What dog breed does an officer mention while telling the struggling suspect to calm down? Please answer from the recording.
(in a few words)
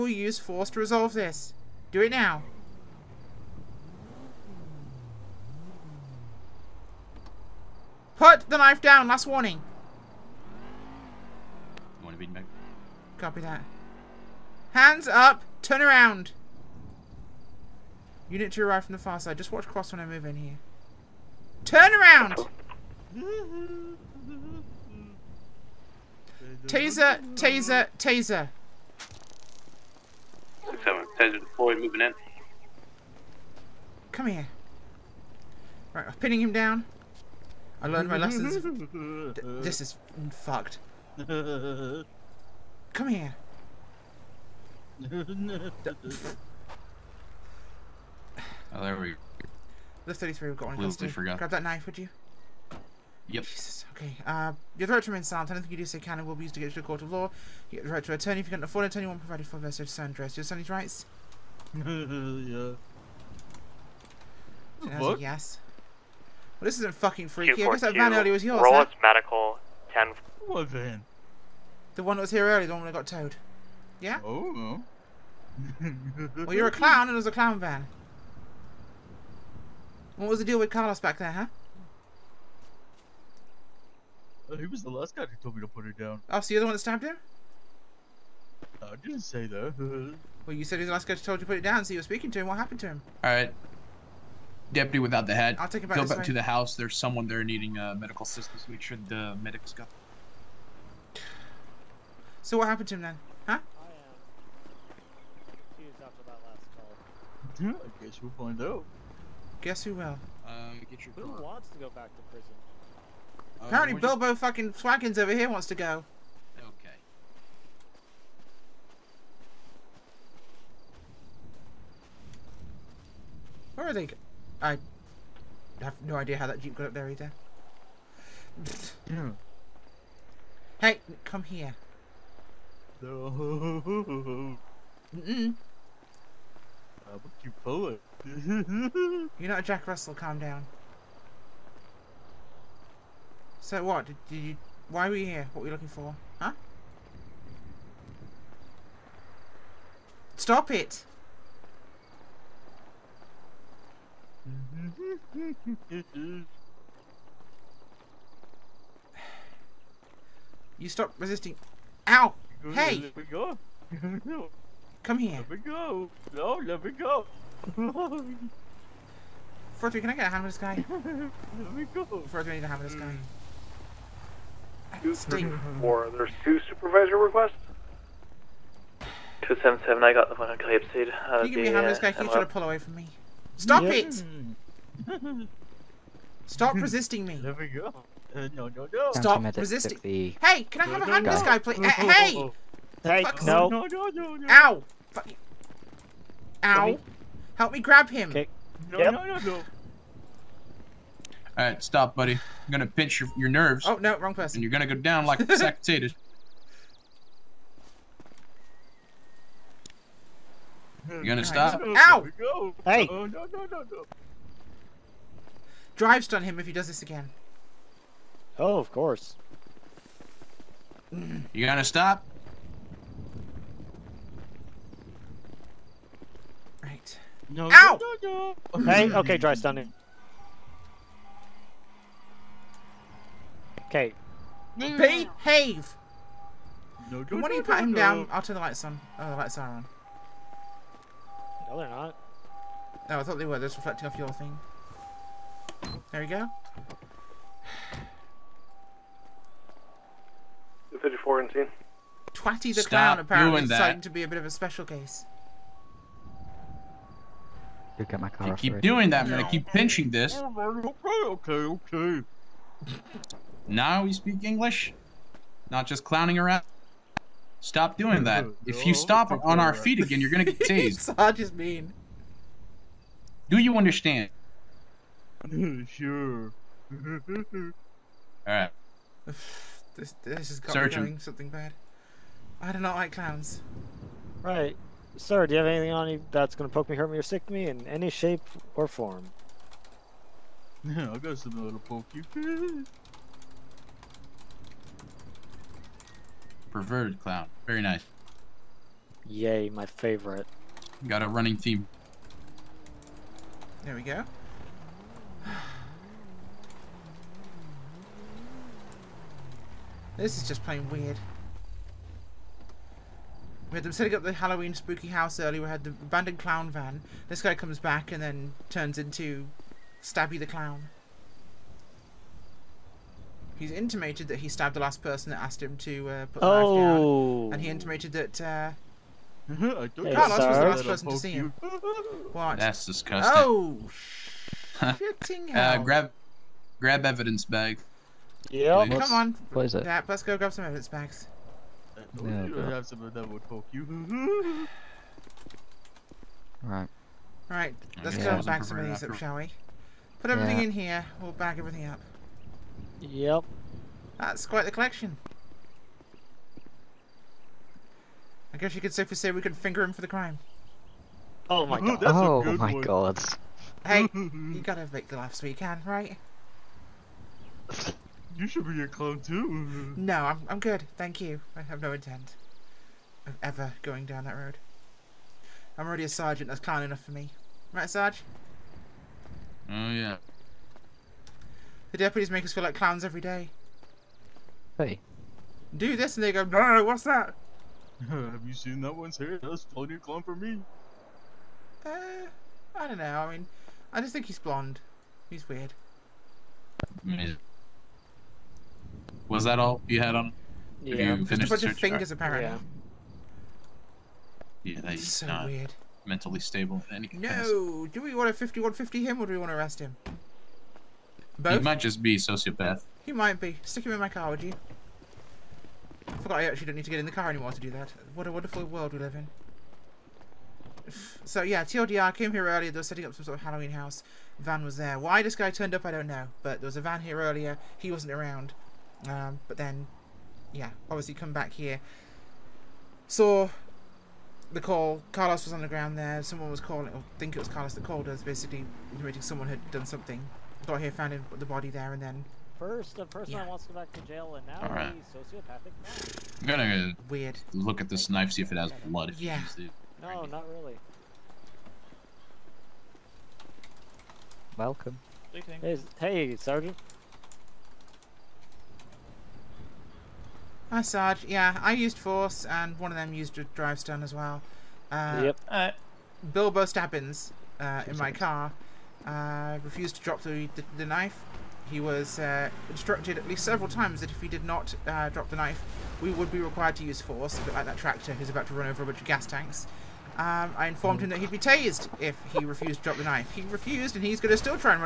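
Jack Russell.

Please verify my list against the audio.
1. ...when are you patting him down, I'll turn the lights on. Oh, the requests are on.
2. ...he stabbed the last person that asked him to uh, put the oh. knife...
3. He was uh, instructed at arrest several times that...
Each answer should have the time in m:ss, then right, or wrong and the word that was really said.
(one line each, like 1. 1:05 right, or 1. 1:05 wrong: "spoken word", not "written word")
1. 3:57 wrong: "lights", not "requests"
2. 5:24 right
3. 7:51 wrong: "least", not "arrest".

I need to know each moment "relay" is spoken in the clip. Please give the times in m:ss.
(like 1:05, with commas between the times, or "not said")
not said.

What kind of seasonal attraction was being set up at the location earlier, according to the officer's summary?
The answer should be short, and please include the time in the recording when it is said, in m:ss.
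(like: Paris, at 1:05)
Halloween spooky house, at 5:14.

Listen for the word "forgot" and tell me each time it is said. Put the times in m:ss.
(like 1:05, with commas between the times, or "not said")
0:51, 6:56.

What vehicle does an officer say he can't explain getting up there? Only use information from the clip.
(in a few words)
jeep.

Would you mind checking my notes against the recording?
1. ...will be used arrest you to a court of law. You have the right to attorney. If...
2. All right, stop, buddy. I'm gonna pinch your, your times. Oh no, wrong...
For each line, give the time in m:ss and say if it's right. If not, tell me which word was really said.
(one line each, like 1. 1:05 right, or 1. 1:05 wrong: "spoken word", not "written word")
1. 0:56 wrong: "against", not "arrest"
2. 3:21 wrong: "nerves", not "times".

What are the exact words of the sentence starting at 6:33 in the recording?
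I mean, I just think he's blonde.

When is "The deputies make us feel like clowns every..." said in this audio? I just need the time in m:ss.
6:21.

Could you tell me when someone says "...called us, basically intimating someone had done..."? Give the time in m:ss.
7:17.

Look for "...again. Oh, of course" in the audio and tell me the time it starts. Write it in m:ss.
3:37.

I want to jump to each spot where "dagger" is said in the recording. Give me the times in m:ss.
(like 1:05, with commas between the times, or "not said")
not said.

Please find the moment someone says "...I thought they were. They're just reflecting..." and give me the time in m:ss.
4:03.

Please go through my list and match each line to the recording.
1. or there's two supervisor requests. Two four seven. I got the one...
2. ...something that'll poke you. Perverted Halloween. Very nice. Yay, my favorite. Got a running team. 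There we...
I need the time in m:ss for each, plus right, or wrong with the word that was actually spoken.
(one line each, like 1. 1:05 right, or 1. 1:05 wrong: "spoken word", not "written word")
1. 2:55 wrong: "seven", not "four"
2. 4:51 wrong: "Clown", not "Halloween".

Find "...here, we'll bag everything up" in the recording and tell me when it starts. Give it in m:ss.
5:50.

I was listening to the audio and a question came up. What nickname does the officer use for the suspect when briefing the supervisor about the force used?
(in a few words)
Bilbo Stabbins.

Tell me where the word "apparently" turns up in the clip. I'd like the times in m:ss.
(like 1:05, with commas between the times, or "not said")
1:53, 4:13, 6:42.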